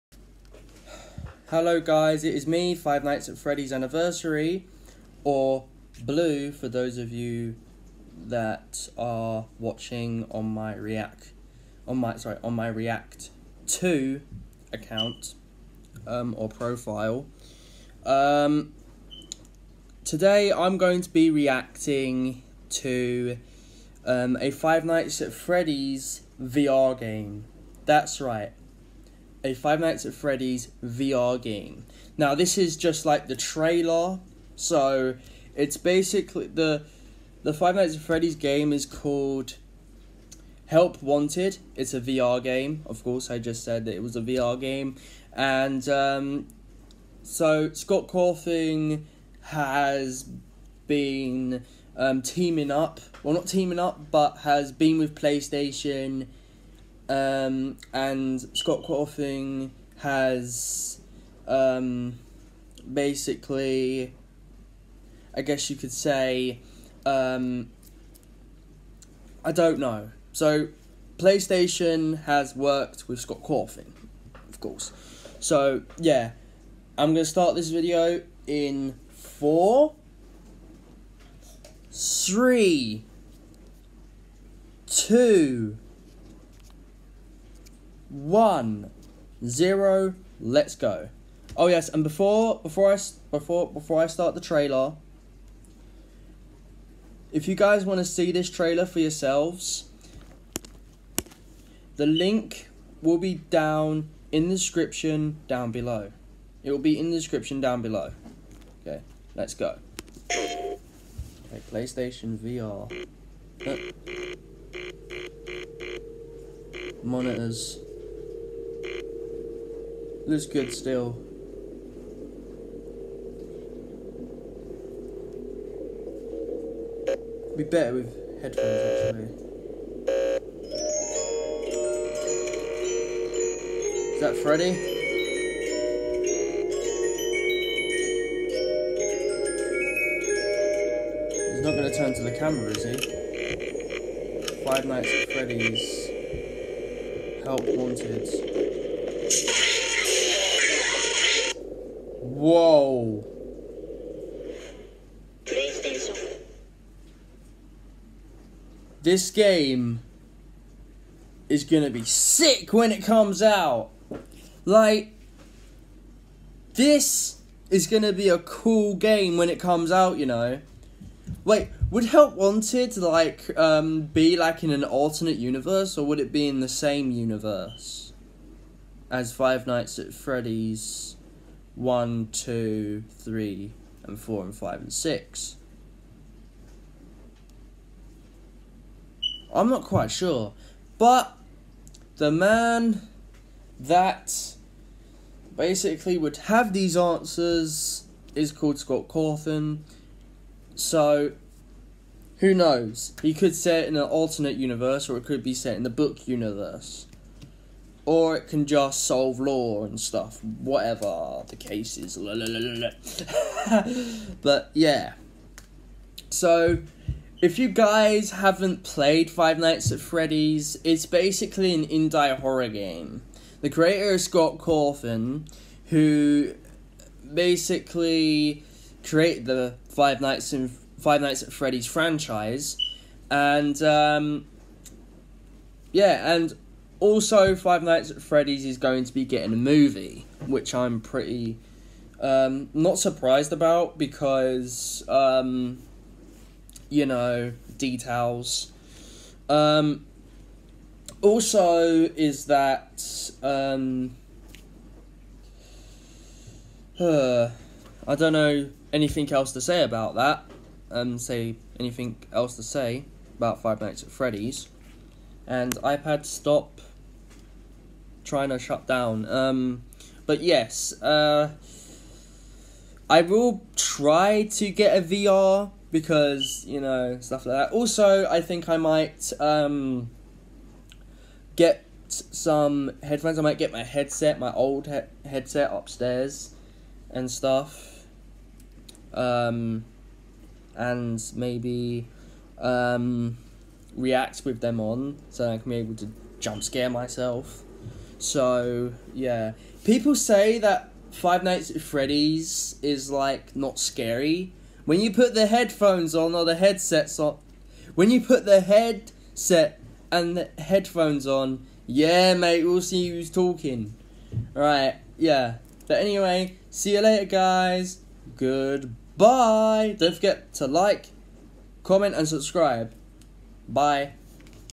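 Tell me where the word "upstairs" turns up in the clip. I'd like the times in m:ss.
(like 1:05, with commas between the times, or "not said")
4:45.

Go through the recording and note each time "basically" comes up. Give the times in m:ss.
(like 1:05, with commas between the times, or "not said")
0:35, 1:02, 3:15, 3:41, 3:47.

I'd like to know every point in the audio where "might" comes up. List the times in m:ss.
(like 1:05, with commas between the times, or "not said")
4:38, 4:43.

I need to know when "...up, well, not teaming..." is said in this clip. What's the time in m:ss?
0:52.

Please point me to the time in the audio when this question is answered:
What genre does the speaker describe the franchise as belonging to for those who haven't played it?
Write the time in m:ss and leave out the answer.
3:41.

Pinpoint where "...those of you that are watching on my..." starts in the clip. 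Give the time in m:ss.
0:06.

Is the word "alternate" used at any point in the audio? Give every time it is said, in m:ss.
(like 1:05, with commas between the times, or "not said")
2:54, 3:24.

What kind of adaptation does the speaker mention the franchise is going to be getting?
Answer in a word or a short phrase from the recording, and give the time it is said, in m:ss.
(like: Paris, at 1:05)
a movie, at 3:59.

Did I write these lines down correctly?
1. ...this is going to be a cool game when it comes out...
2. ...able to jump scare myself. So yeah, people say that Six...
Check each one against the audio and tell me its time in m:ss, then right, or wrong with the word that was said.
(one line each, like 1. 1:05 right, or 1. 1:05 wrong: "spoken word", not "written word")
1. 2:46 right
2. 4:55 wrong: "Five", not "Six".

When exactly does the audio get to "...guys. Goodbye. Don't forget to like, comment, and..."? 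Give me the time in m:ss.
5:17.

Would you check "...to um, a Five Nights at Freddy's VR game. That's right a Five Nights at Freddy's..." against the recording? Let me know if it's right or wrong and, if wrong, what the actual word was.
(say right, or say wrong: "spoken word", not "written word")
right.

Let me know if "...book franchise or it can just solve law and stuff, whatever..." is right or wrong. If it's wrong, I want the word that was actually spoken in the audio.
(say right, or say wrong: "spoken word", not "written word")
wrong: "universe", not "franchise".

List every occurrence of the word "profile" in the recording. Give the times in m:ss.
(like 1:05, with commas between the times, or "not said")
0:16.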